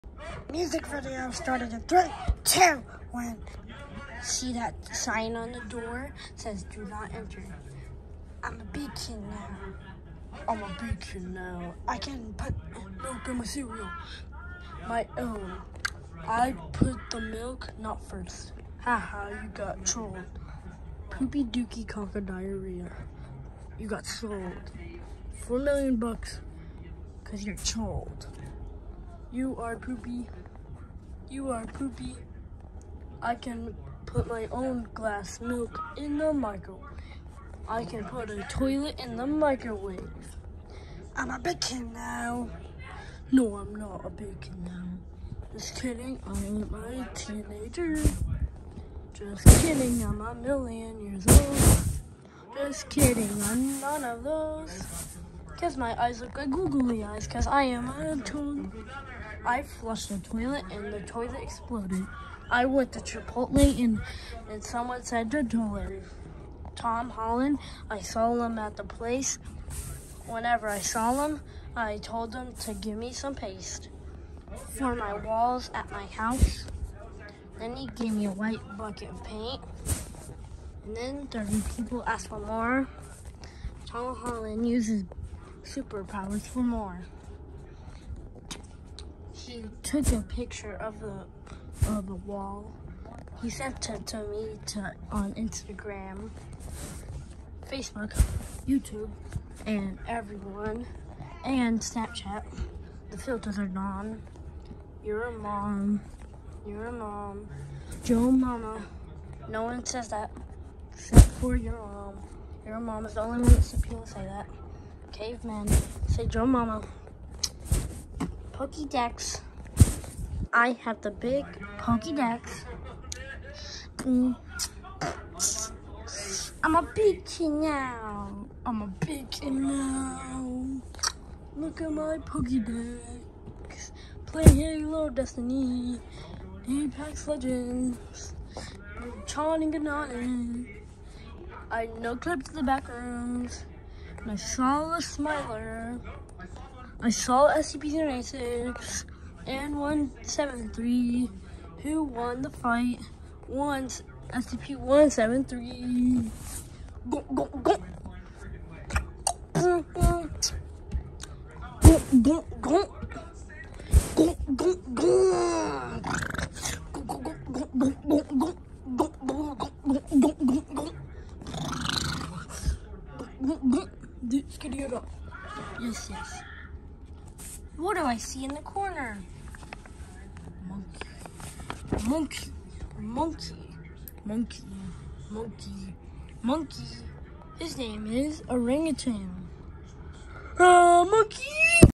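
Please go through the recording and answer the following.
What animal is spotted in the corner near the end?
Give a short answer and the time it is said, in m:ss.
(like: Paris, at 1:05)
Orangutan, at 3:08.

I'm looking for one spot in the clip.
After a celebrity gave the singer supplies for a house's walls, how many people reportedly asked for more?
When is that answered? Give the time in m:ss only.
1:21.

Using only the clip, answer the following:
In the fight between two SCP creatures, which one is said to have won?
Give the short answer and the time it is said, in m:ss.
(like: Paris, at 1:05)
SCP-173, at 2:34.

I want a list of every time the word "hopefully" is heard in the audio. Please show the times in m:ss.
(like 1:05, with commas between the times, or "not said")
not said.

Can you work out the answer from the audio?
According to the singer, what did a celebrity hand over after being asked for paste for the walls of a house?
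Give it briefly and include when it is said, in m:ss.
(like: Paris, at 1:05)
White bucket of paint, at 1:18.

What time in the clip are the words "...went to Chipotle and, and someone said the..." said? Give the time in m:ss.
1:02.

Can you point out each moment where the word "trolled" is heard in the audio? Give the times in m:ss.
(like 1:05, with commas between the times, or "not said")
0:19, 0:27.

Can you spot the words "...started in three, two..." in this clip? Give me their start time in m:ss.
0:01.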